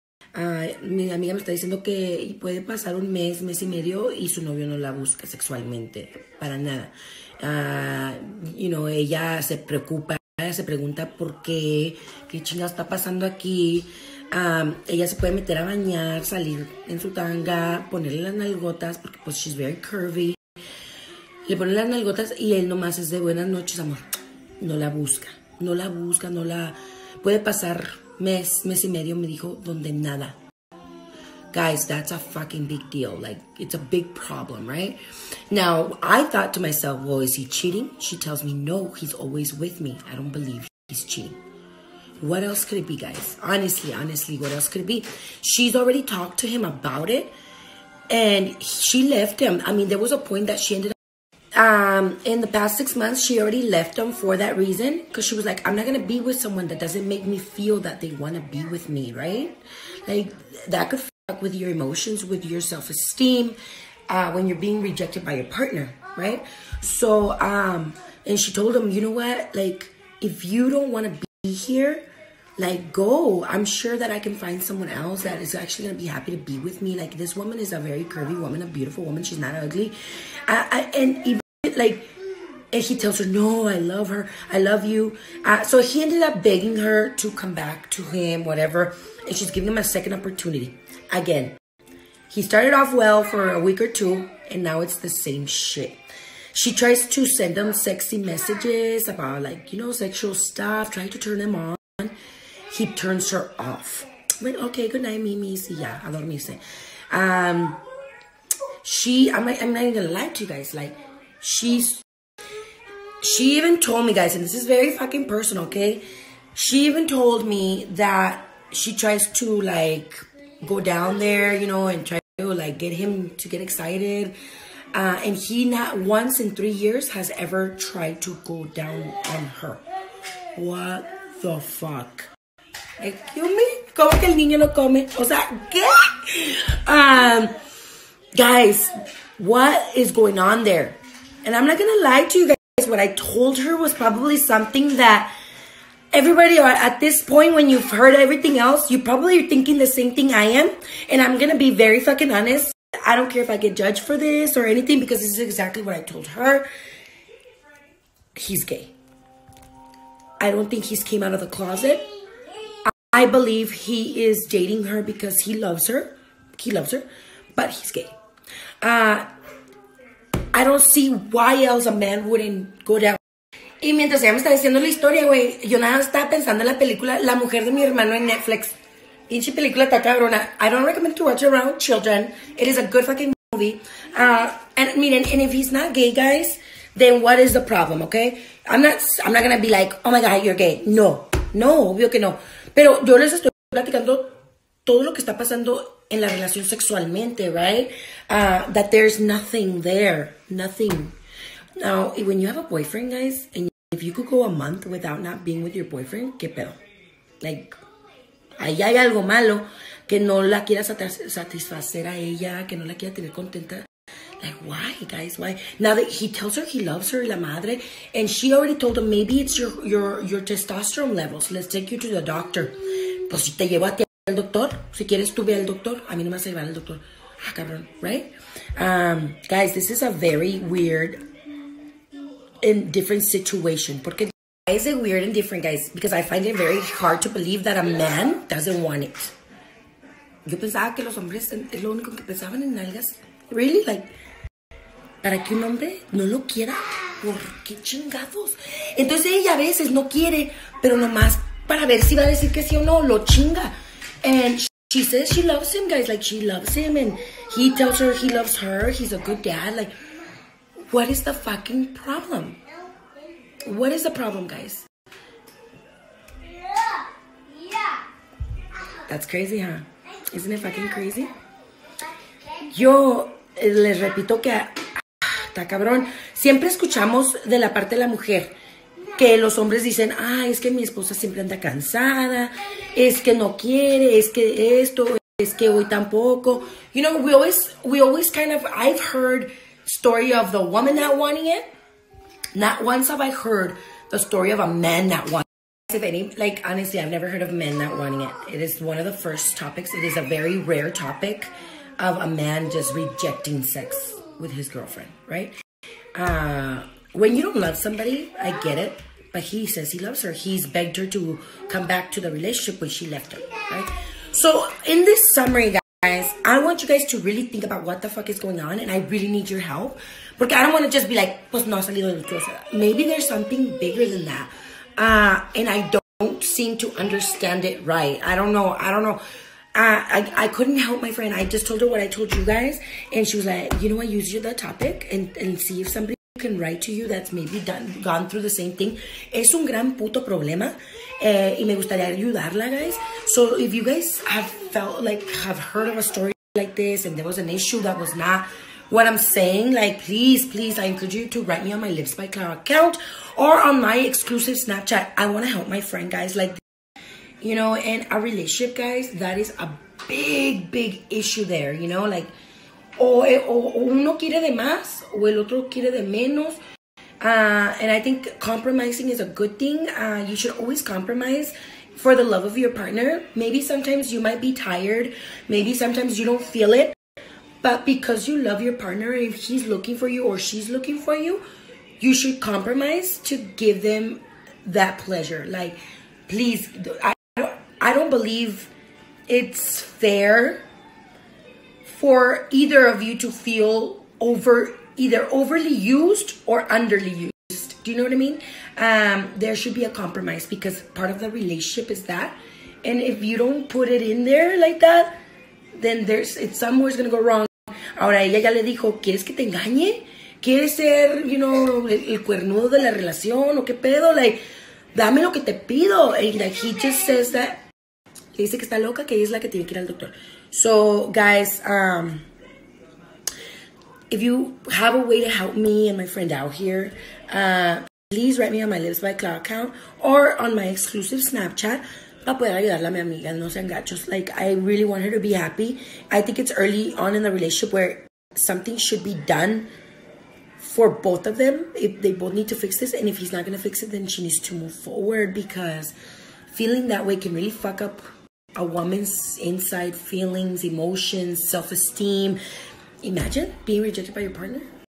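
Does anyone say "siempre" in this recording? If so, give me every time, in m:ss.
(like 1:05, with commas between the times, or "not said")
4:36, 4:41.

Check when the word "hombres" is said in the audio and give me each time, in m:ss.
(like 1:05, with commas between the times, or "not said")
4:01, 4:05, 4:39.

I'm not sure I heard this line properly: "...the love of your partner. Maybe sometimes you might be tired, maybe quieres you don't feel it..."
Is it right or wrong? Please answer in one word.
wrong.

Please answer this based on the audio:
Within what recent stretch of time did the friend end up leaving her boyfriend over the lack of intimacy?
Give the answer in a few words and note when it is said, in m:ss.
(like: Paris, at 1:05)
past six months, at 0:52.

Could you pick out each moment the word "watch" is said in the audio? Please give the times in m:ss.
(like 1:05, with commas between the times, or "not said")
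3:01.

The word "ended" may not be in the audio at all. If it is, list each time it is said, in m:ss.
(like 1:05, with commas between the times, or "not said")
0:50, 1:26.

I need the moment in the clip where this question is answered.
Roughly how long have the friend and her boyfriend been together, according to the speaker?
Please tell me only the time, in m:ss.
2:06.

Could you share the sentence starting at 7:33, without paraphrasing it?
Imagine being rejected by your partner.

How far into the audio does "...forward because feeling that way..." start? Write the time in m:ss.
7:24.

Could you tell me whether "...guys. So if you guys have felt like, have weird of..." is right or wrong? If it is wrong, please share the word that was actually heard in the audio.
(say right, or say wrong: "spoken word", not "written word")
wrong: "heard", not "weird".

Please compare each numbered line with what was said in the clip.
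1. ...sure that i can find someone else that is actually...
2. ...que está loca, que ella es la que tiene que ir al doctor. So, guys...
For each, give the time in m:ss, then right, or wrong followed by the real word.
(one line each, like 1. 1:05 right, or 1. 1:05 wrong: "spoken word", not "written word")
1. 1:13 right
2. 6:58 right.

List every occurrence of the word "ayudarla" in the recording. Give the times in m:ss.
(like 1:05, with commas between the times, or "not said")
5:42, 7:12.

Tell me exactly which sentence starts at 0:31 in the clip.
Guys, that's a fucking big deal.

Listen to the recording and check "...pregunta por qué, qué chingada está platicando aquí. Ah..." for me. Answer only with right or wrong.
wrong.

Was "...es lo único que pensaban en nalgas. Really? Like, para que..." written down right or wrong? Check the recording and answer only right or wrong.
right.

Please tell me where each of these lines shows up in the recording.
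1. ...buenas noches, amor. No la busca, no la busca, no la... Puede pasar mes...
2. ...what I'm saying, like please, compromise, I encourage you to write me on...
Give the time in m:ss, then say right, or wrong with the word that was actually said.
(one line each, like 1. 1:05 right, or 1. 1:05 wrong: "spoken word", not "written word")
1. 0:23 right
2. 5:48 wrong: "please", not "compromise".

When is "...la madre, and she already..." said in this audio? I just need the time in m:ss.
3:37.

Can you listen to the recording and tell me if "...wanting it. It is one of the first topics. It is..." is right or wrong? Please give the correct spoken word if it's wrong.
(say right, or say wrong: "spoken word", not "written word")
right.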